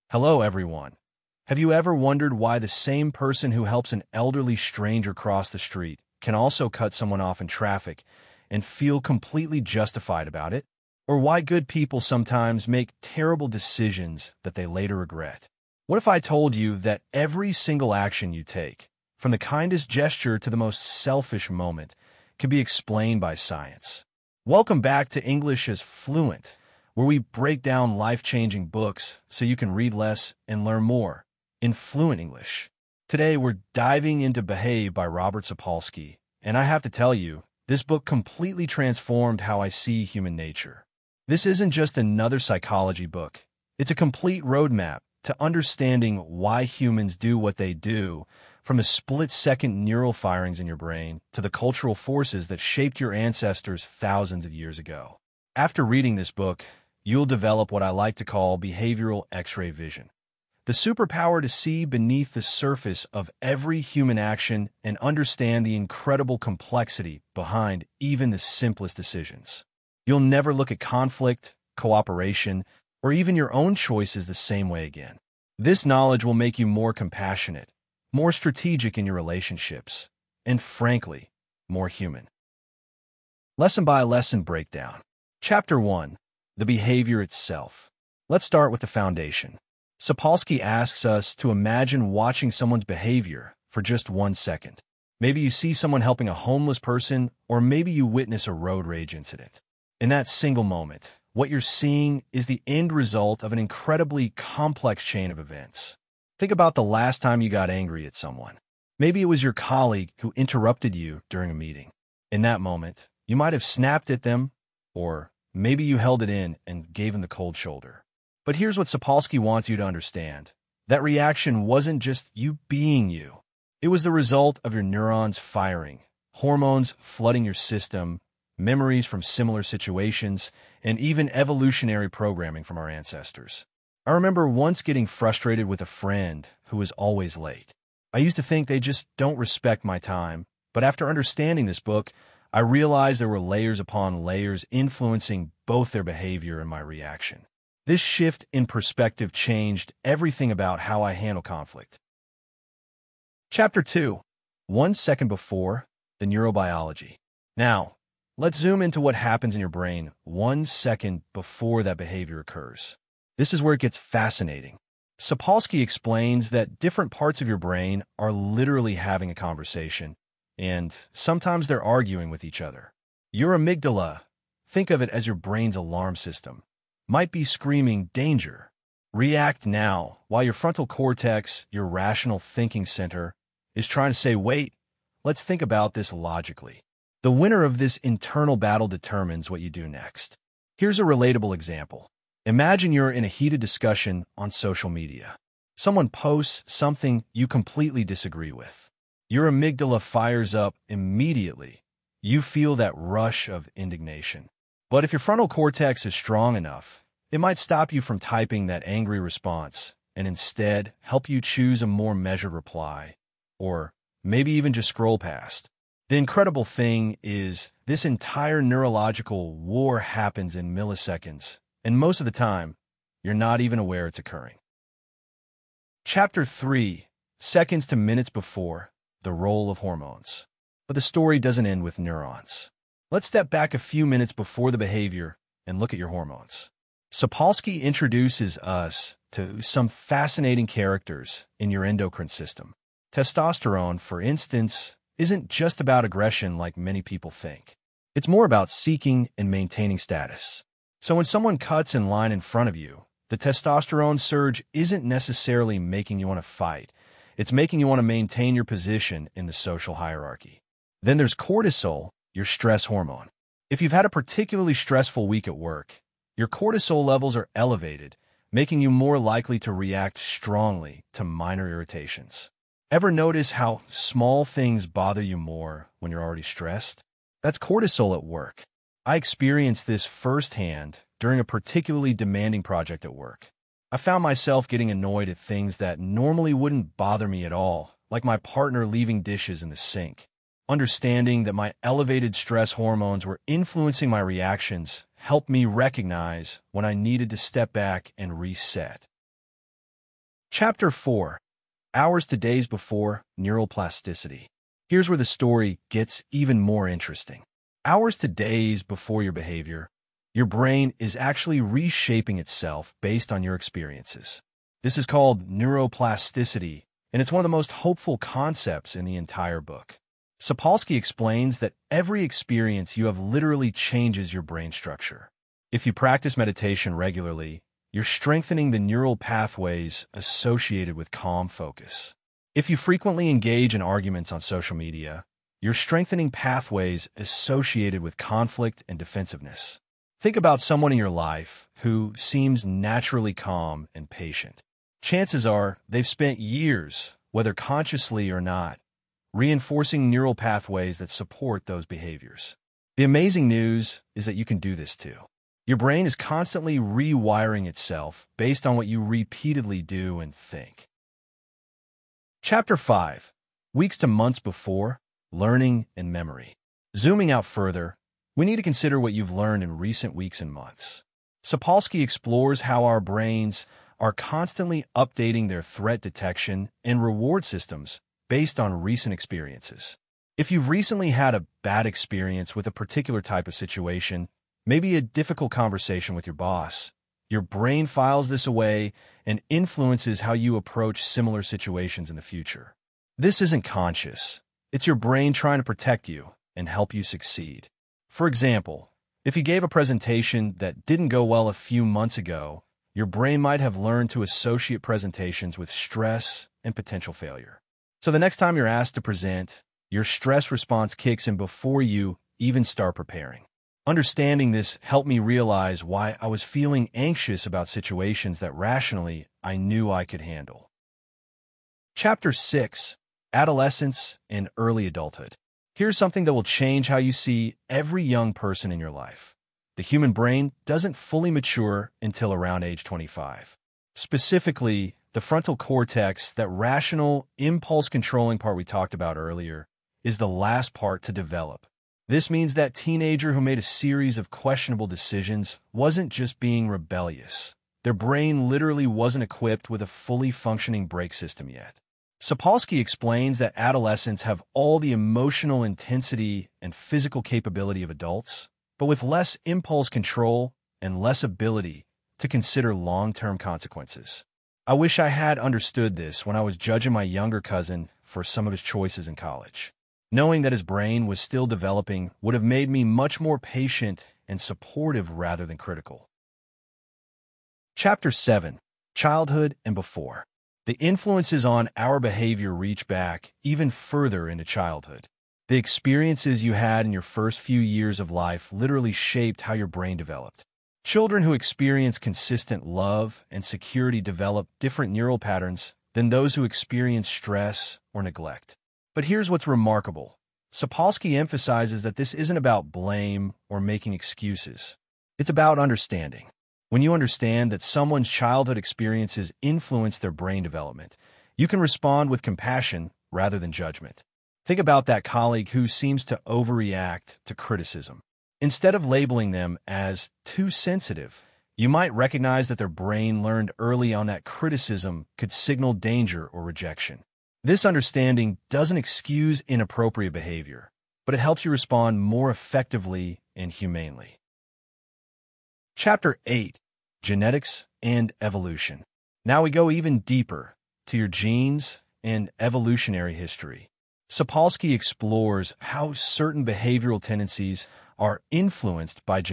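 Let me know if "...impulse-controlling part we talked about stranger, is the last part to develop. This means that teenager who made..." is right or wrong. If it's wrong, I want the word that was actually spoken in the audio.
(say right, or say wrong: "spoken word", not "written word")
wrong: "earlier", not "stranger".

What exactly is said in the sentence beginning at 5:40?
Think about someone in your life who seems naturally calm and patient.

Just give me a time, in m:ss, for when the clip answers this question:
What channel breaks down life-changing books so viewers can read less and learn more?
0:25.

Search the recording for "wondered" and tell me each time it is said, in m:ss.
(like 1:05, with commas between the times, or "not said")
0:01.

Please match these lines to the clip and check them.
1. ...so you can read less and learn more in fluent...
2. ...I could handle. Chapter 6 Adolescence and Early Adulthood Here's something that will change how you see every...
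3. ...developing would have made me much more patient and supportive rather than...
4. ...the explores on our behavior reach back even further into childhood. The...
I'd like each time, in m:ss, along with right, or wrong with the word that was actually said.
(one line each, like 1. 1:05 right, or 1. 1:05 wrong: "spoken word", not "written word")
1. 0:29 right
2. 6:59 right
3. 7:51 right
4. 8:00 wrong: "influences", not "explores".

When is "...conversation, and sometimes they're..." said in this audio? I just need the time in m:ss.
2:49.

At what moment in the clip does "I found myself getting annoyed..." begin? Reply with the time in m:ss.
4:43.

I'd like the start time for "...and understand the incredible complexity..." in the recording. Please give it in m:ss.
1:04.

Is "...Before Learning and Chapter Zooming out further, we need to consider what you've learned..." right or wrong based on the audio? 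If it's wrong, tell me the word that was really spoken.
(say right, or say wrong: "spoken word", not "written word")
wrong: "Memory", not "Chapter".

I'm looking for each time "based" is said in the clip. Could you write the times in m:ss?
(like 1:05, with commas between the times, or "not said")
5:13, 5:58, 6:18.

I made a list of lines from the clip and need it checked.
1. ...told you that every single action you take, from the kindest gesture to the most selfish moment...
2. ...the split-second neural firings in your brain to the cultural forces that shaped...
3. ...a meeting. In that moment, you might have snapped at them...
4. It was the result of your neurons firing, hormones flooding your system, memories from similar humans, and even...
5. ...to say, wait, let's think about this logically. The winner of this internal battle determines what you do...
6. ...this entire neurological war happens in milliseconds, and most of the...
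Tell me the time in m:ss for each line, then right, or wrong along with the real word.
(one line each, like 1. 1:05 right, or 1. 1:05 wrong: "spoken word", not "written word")
1. 0:16 right
2. 0:48 right
3. 1:51 right
4. 2:03 wrong: "situations", not "humans"
5. 3:04 right
6. 3:37 right.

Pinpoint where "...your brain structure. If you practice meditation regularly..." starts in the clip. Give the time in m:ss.
5:24.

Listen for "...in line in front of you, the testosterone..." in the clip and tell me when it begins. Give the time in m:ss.
4:11.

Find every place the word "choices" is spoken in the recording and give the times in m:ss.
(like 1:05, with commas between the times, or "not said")
1:13, 7:48.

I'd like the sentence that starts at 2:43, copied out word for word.
This is where it gets fascinating.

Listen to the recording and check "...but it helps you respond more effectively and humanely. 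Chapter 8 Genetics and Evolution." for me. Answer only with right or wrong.
right.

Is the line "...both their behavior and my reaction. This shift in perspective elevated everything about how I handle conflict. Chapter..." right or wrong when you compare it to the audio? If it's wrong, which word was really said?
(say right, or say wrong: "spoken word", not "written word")
wrong: "changed", not "elevated".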